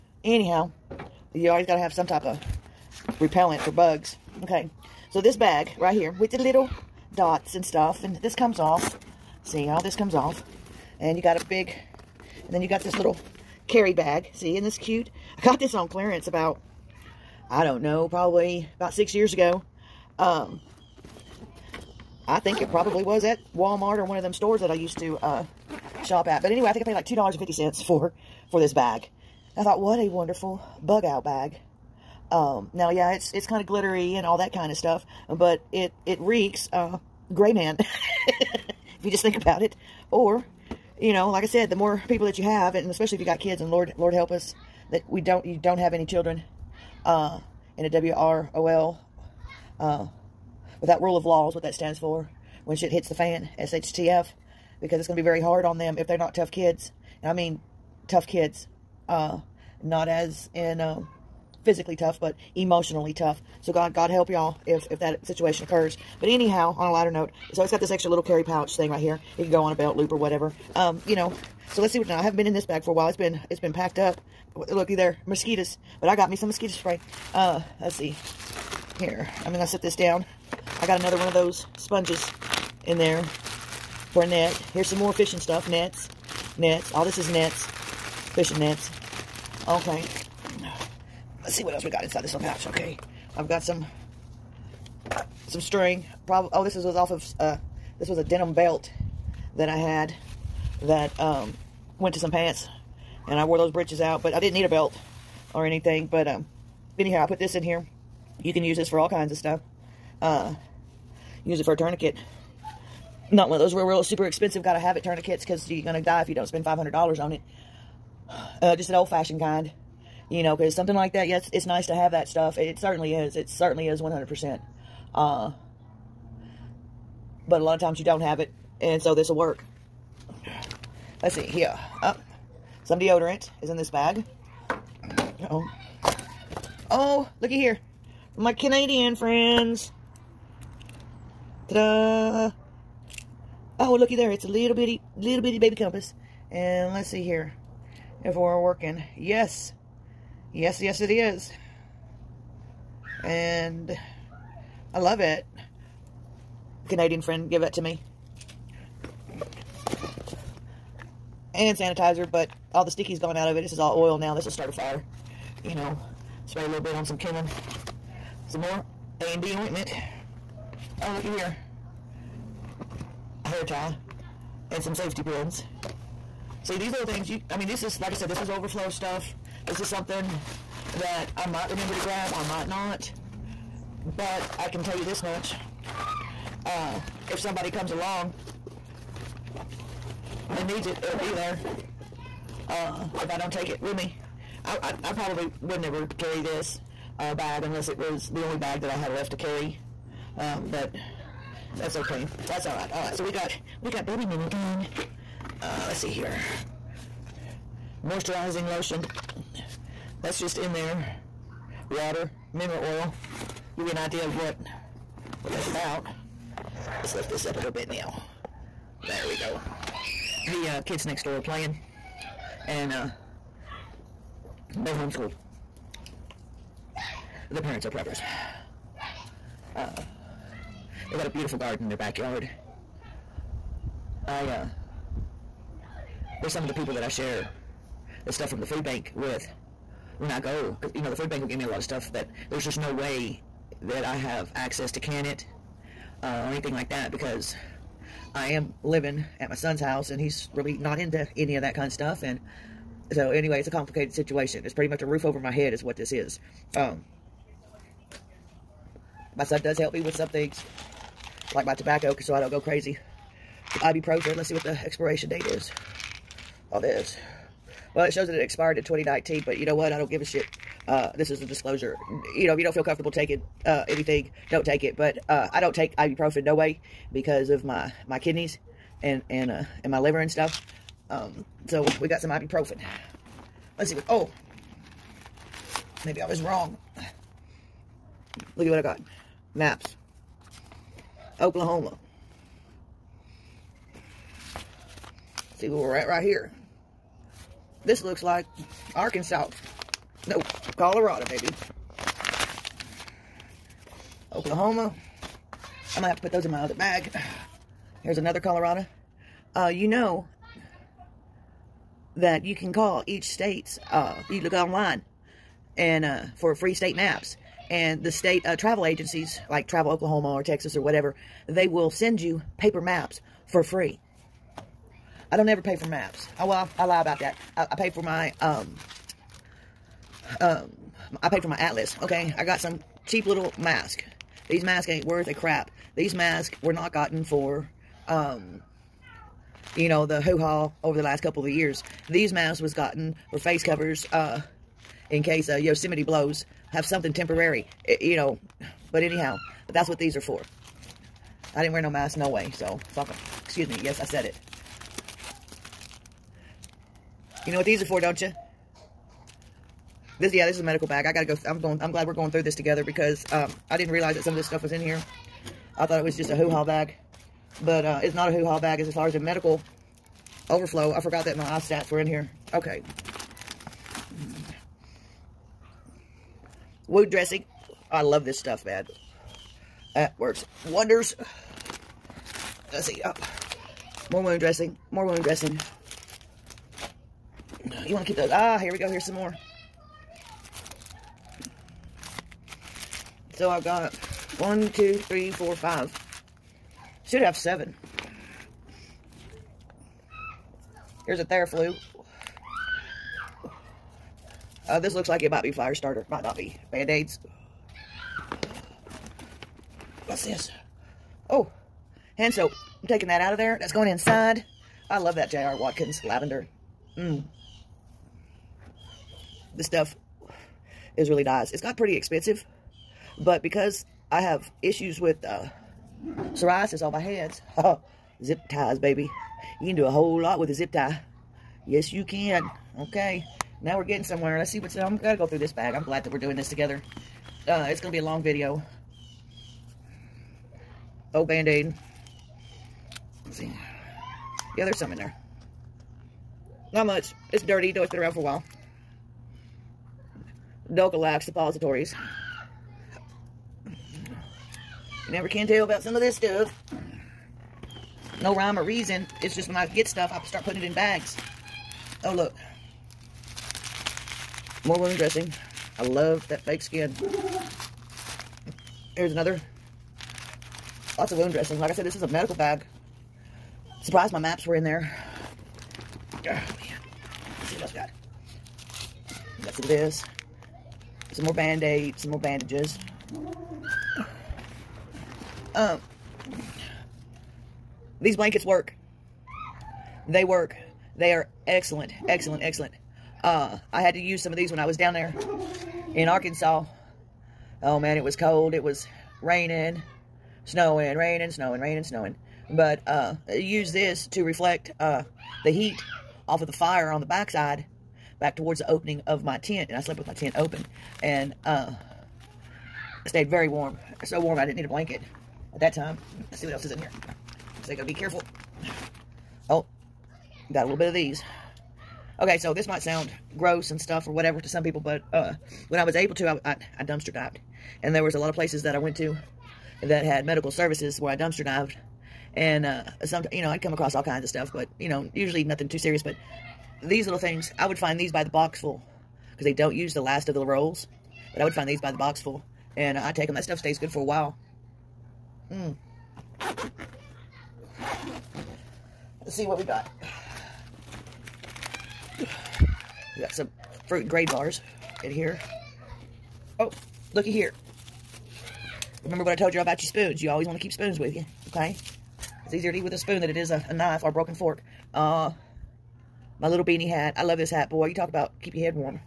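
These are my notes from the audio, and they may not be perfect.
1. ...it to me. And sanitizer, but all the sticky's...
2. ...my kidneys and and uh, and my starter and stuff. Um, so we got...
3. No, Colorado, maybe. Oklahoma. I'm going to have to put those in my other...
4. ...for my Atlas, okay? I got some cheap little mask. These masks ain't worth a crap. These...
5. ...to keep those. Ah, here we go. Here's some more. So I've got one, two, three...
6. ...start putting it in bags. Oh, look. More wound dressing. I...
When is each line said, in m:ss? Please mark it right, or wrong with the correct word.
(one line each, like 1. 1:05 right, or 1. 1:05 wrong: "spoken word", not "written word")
1. 2:37 right
2. 4:38 wrong: "liver", not "starter"
3. 5:00 right
4. 5:31 right
5. 6:28 right
6. 7:40 right.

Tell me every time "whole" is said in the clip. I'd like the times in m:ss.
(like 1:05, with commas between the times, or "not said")
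7:09.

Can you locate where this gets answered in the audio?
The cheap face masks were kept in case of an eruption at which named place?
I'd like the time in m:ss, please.
5:45.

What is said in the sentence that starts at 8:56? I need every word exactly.
But these little things, I would find these by the box full because they don't use the last of the rolls.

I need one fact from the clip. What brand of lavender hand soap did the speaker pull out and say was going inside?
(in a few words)
J.R. Watkins.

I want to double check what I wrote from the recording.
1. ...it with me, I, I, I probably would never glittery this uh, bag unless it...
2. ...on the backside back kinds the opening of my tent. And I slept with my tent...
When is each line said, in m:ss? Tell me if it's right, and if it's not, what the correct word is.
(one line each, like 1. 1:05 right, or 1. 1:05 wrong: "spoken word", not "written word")
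1. 3:13 wrong: "carry", not "glittery"
2. 8:26 wrong: "towards", not "kinds".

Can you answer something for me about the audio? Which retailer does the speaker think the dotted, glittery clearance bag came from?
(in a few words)
Walmart.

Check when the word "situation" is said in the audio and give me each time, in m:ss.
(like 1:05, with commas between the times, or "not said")
1:05, 4:14.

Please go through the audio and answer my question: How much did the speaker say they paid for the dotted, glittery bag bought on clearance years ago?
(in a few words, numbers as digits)
$2.50.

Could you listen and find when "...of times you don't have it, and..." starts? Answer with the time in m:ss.
2:07.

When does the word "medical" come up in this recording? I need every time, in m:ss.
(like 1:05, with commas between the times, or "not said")
6:00, 6:09, 7:52, 8:50.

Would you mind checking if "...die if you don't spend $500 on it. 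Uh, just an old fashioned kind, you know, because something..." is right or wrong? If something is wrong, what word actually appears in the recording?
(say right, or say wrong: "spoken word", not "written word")
right.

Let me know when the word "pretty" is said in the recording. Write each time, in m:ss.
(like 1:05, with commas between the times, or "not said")
4:14, 7:01.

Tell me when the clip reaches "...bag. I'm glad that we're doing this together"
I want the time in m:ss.
7:15.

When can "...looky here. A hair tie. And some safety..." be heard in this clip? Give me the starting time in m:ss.
2:51.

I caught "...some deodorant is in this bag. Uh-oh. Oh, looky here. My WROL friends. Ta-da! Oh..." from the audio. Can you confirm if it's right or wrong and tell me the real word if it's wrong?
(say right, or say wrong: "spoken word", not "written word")
wrong: "Canadian", not "WROL".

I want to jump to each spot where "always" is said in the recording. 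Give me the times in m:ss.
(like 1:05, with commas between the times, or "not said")
0:01, 9:20.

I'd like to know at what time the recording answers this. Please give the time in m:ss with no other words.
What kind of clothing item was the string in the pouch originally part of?
1:38.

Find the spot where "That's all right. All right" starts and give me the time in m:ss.
3:22.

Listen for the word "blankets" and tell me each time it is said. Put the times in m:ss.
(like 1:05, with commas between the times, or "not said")
8:08, 8:34.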